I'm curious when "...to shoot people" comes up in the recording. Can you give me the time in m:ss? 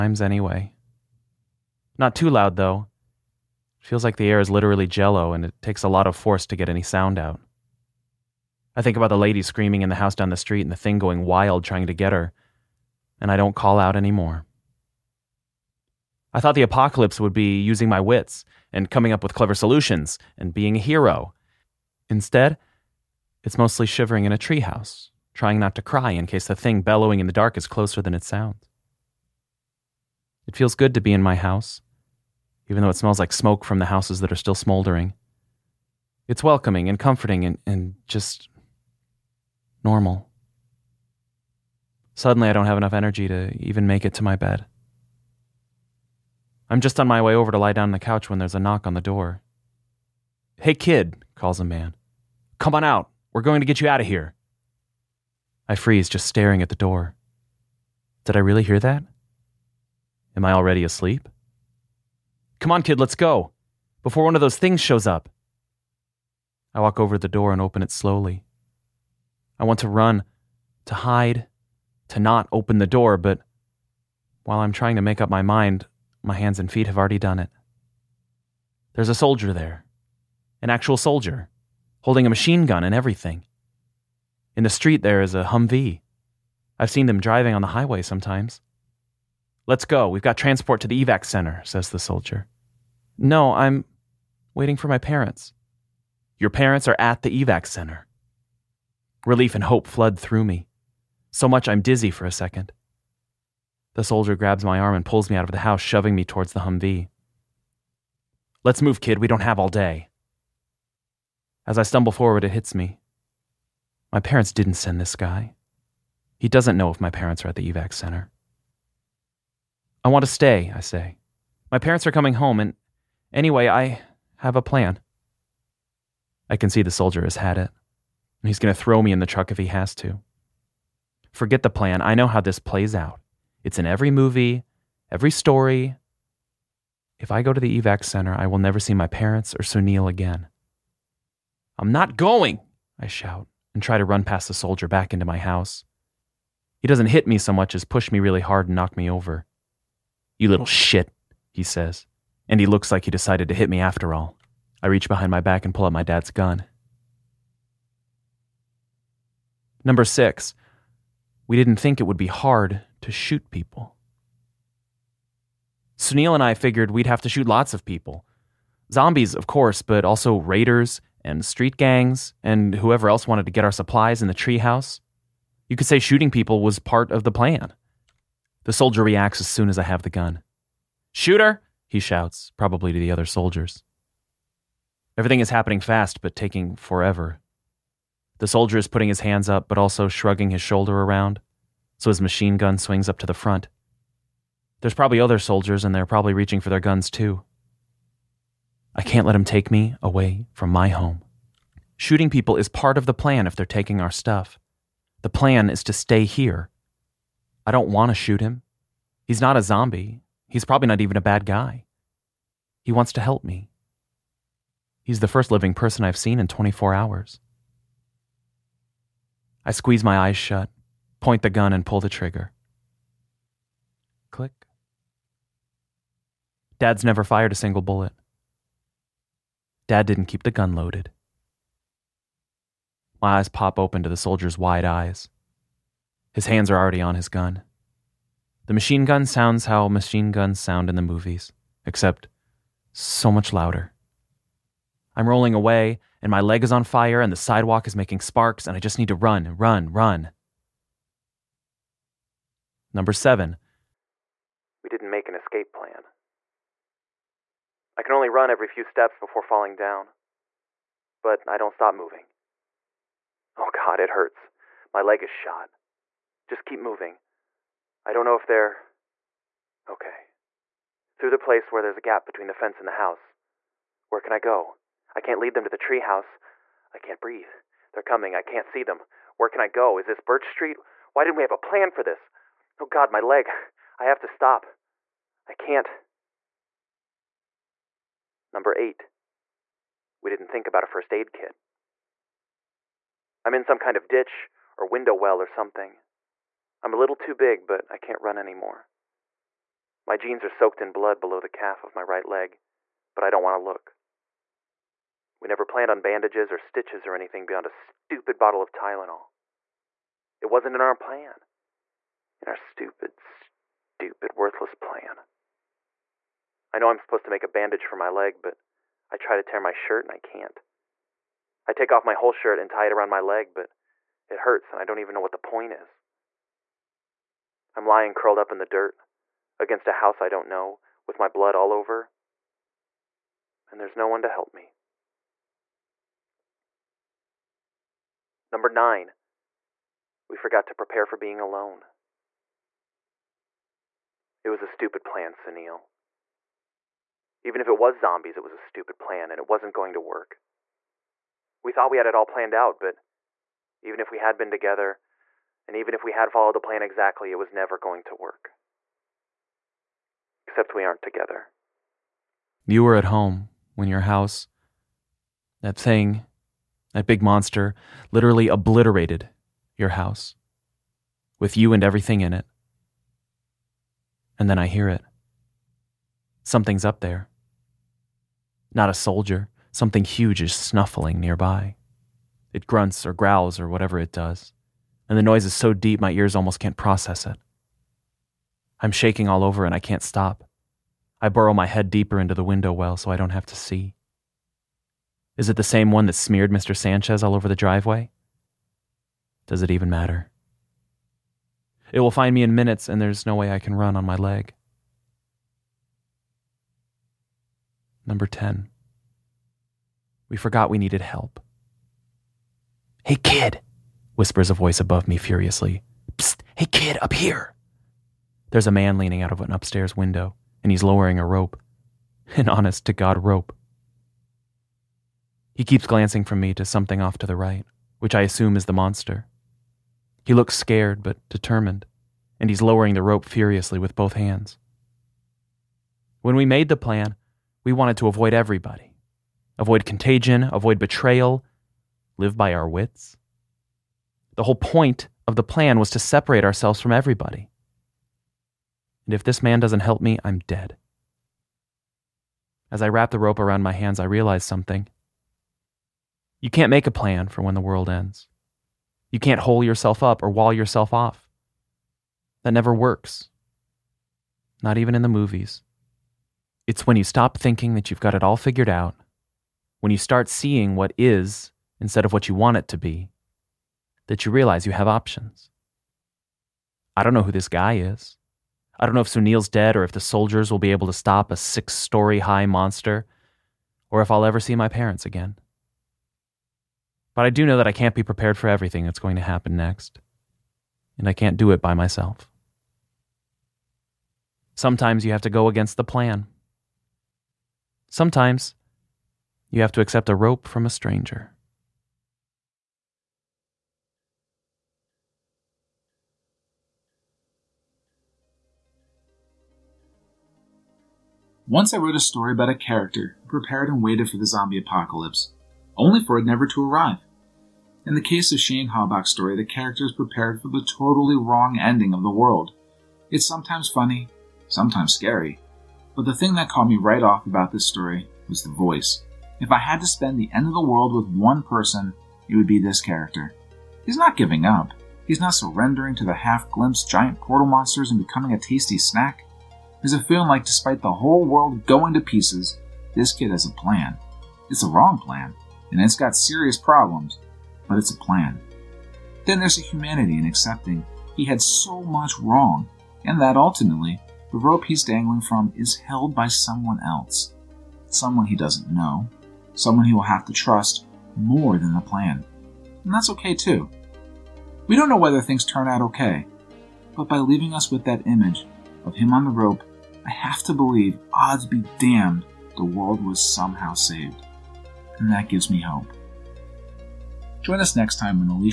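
2:43.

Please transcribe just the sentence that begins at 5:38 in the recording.
Number nine, we forgot to prepare for being alone.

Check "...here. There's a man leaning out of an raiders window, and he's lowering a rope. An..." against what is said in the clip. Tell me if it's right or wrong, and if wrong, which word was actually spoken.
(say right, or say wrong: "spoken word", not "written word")
wrong: "upstairs", not "raiders".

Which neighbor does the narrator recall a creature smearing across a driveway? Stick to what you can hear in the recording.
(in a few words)
Mr. Sanchez.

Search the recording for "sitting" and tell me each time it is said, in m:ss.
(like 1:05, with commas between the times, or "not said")
not said.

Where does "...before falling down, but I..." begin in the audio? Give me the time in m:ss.
4:19.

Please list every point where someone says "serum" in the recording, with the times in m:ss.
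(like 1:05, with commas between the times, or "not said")
not said.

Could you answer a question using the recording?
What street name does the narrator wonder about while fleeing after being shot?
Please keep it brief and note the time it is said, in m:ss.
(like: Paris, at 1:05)
Birch Street, at 4:40.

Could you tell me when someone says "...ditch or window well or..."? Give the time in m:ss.
4:54.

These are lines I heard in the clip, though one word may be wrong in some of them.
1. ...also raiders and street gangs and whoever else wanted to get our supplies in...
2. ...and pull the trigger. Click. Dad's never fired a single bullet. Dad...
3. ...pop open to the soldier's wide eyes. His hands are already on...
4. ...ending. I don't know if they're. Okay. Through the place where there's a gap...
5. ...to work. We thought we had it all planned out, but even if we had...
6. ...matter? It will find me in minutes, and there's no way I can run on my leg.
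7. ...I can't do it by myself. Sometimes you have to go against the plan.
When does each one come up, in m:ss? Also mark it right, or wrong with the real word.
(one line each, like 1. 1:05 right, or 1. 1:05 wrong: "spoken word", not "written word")
1. 2:50 right
2. 3:41 right
3. 3:53 right
4. 4:26 wrong: "moving", not "ending"
5. 5:49 right
6. 6:39 right
7. 8:11 right.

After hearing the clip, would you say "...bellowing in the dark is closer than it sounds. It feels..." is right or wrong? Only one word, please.
right.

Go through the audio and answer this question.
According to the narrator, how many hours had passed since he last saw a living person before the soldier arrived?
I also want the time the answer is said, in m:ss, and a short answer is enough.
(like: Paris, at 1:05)
24, at 3:36.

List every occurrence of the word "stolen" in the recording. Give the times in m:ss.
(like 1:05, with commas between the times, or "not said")
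not said.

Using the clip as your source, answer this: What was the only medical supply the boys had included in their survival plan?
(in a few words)
Tylenol.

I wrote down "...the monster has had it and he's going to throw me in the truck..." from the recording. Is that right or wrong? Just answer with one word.
wrong.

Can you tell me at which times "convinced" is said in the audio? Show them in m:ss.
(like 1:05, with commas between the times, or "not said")
not said.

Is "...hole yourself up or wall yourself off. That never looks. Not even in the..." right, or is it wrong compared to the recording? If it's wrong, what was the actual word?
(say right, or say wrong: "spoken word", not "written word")
wrong: "works", not "looks".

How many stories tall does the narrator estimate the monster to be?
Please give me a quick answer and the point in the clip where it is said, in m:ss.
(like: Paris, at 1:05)
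6, at 8:01.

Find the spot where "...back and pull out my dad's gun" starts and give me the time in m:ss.
2:35.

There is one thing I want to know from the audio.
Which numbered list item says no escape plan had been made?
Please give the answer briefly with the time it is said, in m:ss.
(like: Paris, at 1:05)
Number seven, at 4:12.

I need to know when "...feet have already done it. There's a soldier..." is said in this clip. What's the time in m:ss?
1:16.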